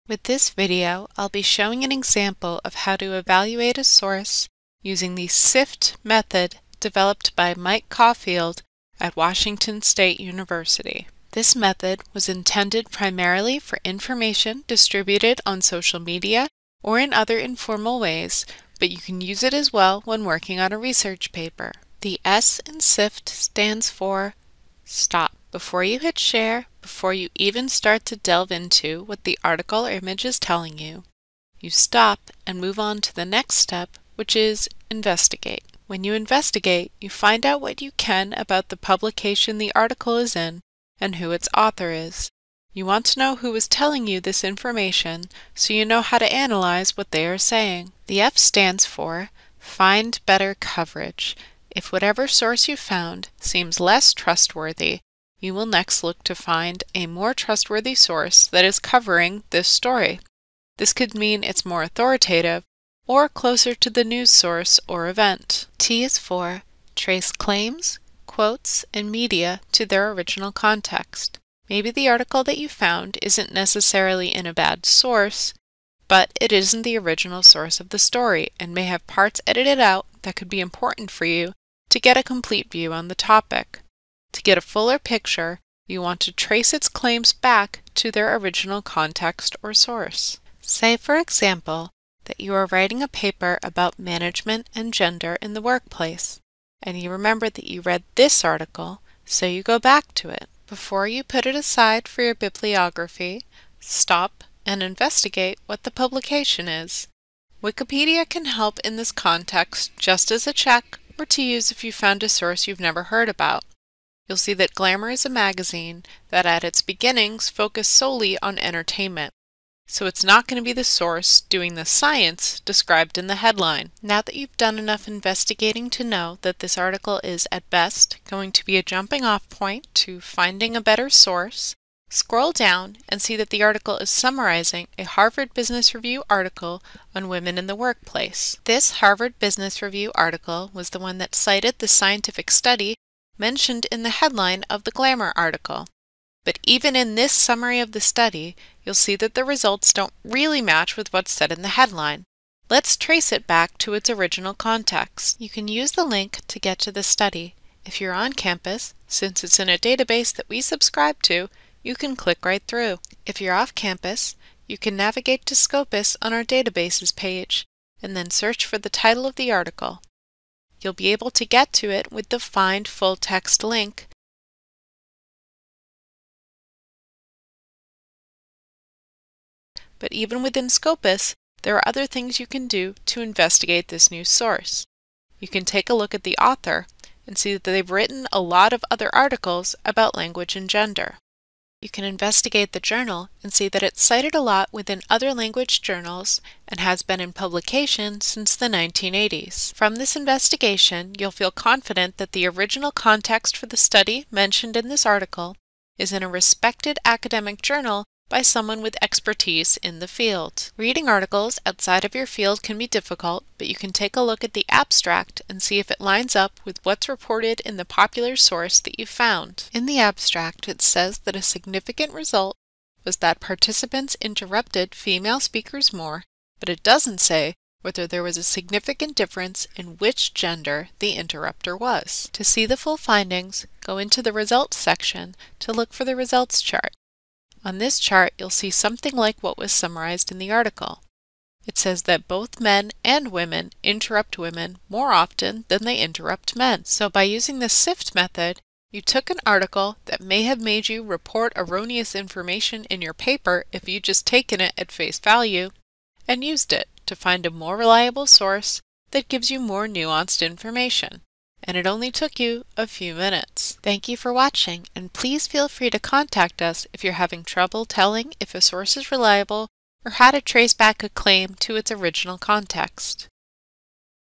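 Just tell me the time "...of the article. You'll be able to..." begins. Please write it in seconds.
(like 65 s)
169 s.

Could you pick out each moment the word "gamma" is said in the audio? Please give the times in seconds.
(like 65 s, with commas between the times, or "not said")
not said.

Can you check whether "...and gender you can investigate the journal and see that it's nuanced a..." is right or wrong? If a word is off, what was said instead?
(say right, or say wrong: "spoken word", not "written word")
wrong: "cited", not "nuanced".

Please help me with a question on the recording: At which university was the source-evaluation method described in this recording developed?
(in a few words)
Washington State University.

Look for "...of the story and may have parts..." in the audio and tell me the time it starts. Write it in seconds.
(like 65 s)
77 s.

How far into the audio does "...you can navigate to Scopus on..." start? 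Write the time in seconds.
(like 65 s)
164 s.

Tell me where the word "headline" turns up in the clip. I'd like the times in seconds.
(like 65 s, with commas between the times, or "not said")
123 s, 144 s, 151 s.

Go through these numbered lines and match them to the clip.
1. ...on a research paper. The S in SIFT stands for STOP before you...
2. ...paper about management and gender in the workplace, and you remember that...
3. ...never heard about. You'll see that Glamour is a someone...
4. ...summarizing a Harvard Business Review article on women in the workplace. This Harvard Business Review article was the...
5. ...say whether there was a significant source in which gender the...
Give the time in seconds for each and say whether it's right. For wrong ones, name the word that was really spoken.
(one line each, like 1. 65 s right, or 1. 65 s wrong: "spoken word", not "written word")
1. 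20 s right
2. 93 s right
3. 112 s wrong: "magazine", not "someone"
4. 134 s right
5. 227 s wrong: "difference", not "source".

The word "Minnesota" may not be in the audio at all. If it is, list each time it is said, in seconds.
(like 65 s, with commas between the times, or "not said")
not said.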